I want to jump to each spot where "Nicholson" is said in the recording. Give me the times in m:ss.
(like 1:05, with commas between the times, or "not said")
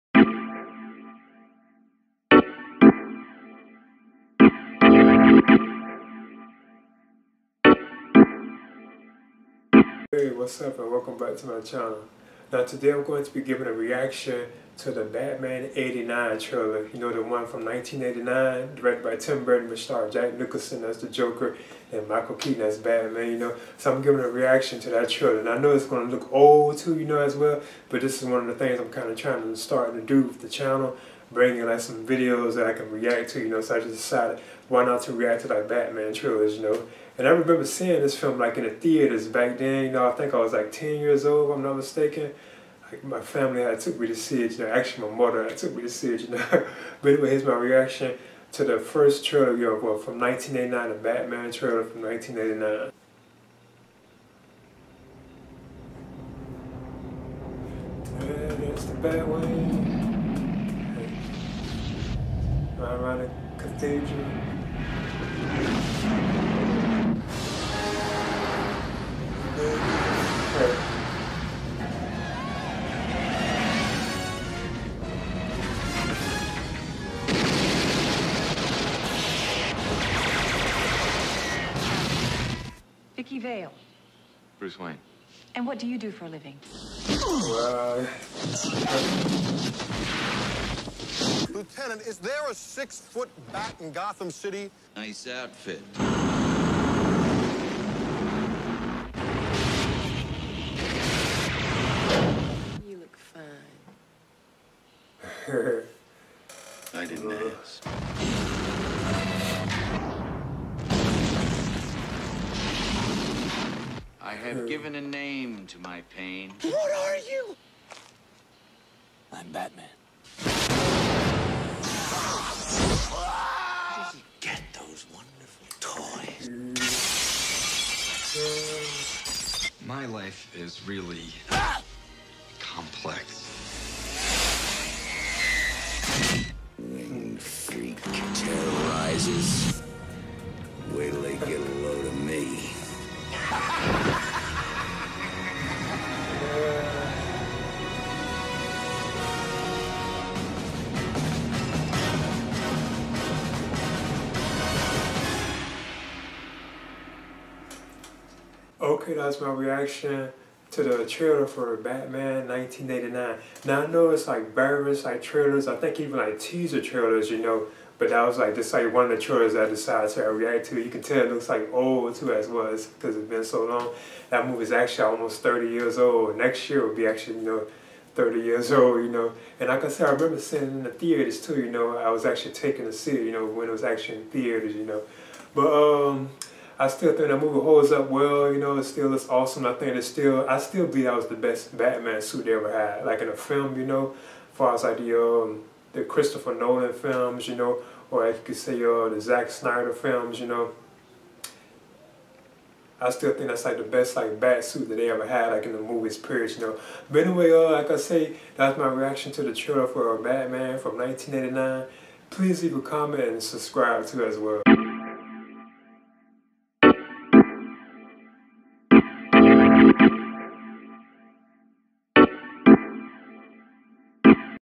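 0:20.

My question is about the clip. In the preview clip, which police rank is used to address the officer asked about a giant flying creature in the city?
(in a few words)
Lieutenant.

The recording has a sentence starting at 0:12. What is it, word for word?
Now today I'm going to be giving a reaction to the Batman 89 trailer.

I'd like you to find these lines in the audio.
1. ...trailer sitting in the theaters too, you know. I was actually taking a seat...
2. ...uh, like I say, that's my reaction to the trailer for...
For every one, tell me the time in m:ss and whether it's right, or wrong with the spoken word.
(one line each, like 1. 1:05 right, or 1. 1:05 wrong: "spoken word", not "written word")
1. 3:00 wrong: "remember", not "trailer"
2. 3:27 right.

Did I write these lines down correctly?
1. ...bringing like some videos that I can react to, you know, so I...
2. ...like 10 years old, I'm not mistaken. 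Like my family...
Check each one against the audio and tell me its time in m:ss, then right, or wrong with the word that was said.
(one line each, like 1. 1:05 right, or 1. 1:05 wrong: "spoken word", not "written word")
1. 0:31 right
2. 0:40 right.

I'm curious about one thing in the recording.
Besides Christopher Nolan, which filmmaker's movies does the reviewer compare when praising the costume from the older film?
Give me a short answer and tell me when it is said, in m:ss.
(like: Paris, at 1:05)
Zack Snyder, at 3:19.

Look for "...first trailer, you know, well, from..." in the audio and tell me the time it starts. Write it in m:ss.
0:48.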